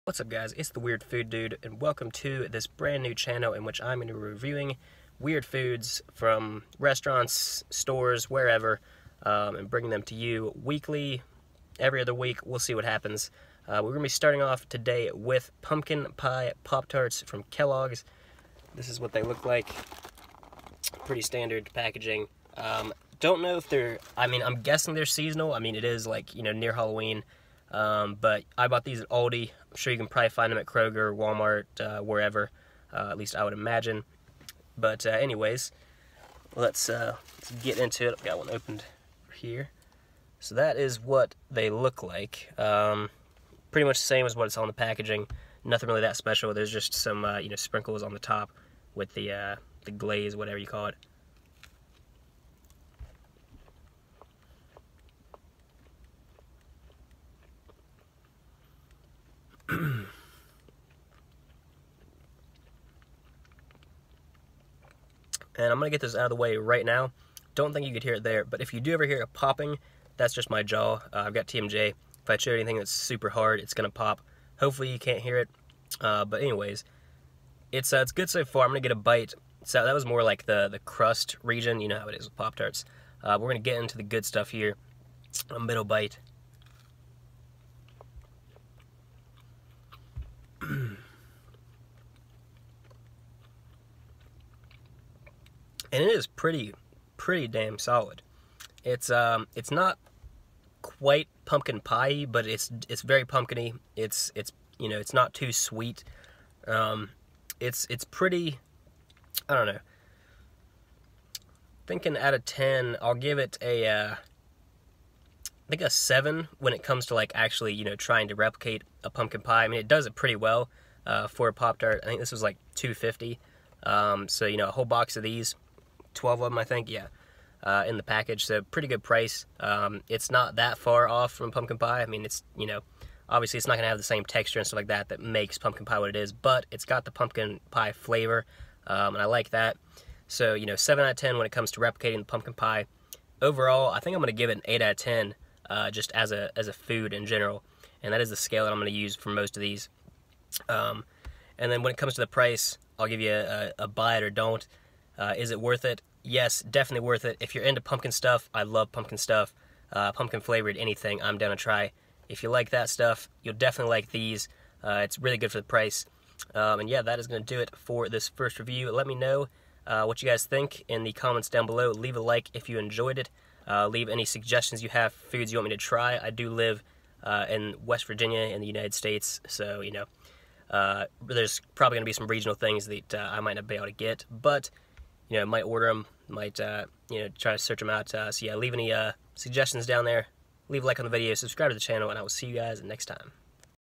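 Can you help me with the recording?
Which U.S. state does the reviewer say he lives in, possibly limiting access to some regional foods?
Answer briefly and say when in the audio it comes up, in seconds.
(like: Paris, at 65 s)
West Virginia, at 177 s.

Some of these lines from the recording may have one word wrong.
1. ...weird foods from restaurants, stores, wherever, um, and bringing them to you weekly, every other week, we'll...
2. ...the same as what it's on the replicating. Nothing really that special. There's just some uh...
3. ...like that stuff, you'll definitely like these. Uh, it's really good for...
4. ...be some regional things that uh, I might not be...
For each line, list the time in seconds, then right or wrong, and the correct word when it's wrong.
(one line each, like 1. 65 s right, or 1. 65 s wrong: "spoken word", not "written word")
1. 5 s right
2. 43 s wrong: "packaging", not "replicating"
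3. 162 s right
4. 182 s right.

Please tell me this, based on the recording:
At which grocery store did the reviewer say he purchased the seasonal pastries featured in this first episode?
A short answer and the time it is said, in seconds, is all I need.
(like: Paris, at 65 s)
Aldi, at 29 s.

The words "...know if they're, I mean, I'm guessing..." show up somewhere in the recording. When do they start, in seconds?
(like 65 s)
23 s.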